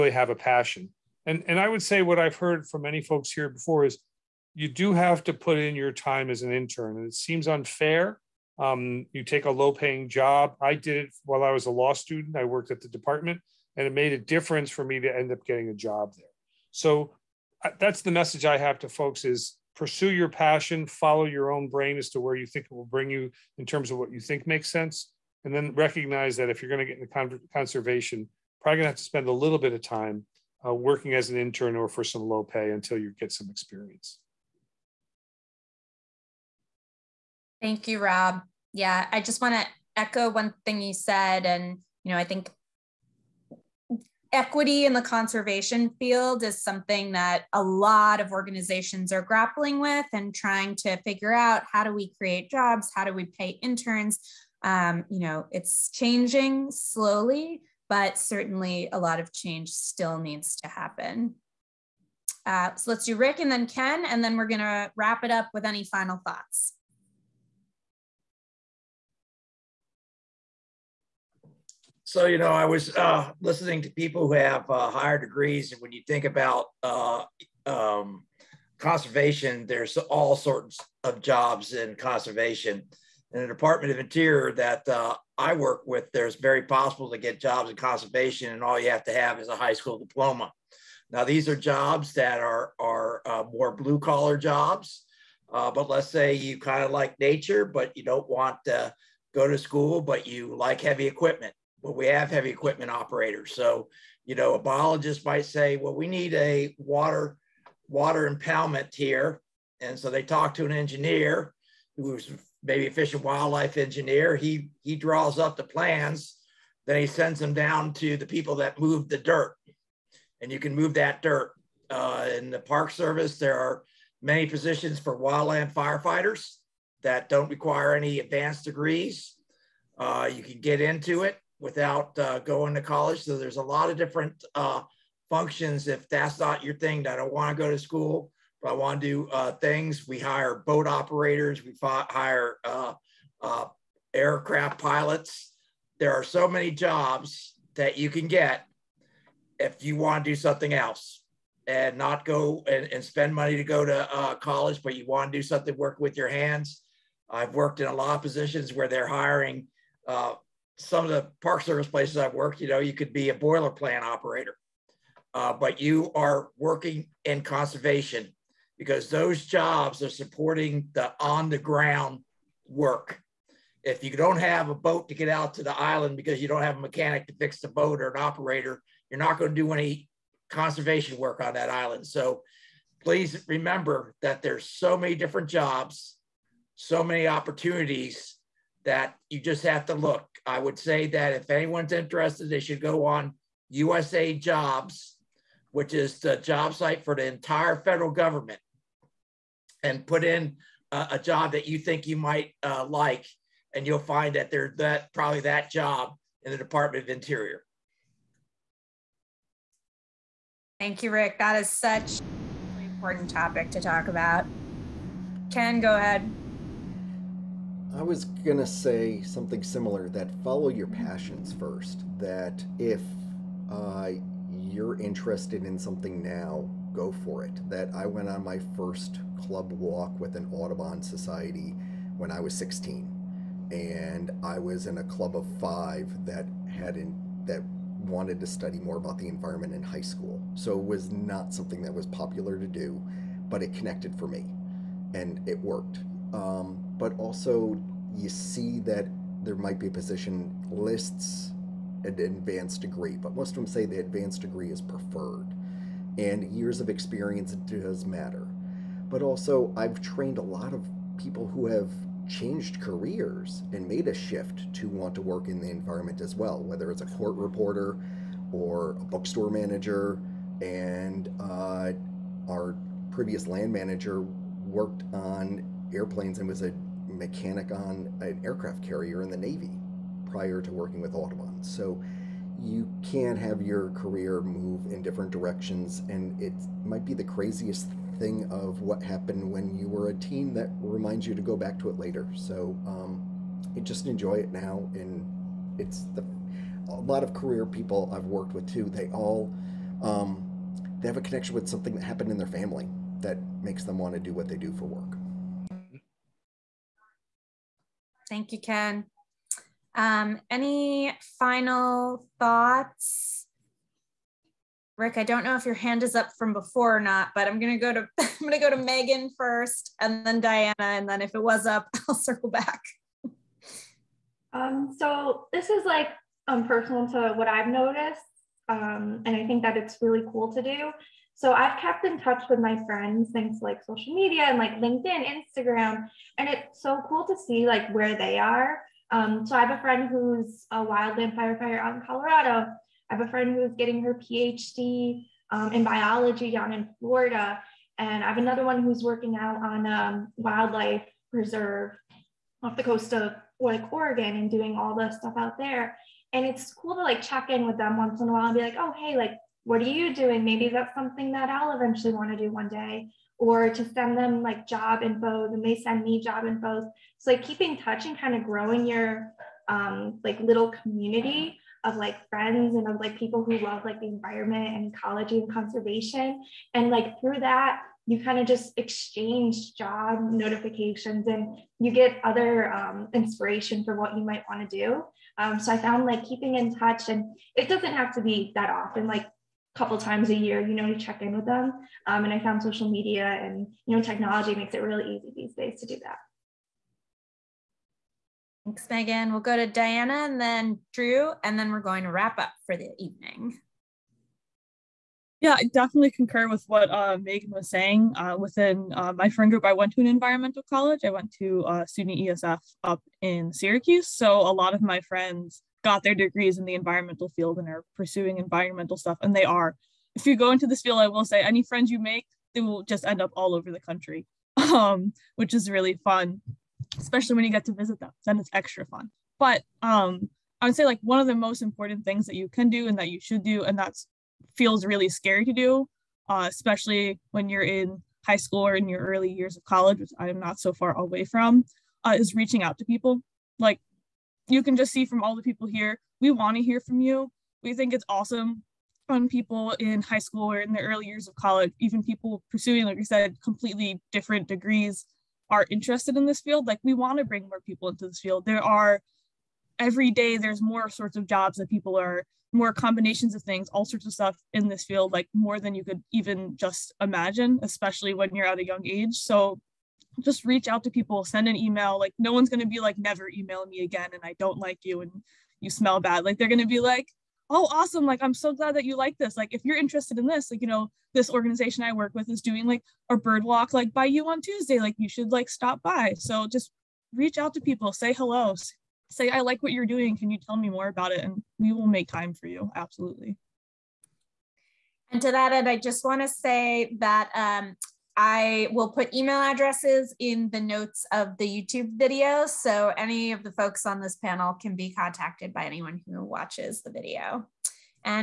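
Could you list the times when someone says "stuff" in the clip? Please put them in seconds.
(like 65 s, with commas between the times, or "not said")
355 s, 418 s, 464 s.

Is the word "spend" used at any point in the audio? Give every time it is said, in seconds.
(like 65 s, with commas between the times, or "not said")
29 s, 153 s.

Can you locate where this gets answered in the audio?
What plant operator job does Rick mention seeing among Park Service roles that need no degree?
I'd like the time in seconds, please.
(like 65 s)
163 s.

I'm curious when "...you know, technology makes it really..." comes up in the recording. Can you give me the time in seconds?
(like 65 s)
393 s.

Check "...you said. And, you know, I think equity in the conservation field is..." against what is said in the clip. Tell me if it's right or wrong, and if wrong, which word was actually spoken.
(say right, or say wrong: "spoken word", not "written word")
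right.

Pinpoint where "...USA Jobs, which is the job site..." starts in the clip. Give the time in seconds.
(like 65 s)
193 s.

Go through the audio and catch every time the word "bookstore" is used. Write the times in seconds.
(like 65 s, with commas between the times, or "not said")
269 s.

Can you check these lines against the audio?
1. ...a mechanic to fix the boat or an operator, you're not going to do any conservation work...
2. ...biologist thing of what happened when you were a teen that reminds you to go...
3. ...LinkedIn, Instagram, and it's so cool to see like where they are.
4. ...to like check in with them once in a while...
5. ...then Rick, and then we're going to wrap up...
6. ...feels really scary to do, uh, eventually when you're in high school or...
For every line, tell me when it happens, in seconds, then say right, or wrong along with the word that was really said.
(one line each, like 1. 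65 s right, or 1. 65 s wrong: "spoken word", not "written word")
1. 176 s right
2. 287 s wrong: "craziest", not "biologist"
3. 334 s right
4. 356 s right
5. 400 s wrong: "Drew", not "Rick"
6. 434 s wrong: "especially", not "eventually".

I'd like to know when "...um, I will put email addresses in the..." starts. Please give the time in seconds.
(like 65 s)
497 s.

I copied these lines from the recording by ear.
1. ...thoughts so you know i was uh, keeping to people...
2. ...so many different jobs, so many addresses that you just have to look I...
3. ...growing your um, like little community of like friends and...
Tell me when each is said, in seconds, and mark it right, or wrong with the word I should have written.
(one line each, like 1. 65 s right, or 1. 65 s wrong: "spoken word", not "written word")
1. 66 s wrong: "listening", not "keeping"
2. 184 s wrong: "opportunities", not "addresses"
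3. 368 s right.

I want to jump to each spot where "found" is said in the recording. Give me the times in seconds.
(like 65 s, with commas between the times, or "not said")
385 s, 392 s.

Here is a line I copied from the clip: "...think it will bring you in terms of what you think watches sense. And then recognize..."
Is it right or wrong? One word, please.
wrong.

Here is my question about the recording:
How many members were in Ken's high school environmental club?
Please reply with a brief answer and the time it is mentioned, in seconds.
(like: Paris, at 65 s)
5, at 235 s.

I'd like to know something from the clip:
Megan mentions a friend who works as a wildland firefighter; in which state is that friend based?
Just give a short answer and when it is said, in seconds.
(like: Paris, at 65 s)
Colorado, at 342 s.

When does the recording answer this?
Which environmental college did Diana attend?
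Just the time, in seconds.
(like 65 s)
411 s.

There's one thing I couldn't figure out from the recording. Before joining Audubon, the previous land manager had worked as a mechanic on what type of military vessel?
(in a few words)
aircraft carrier.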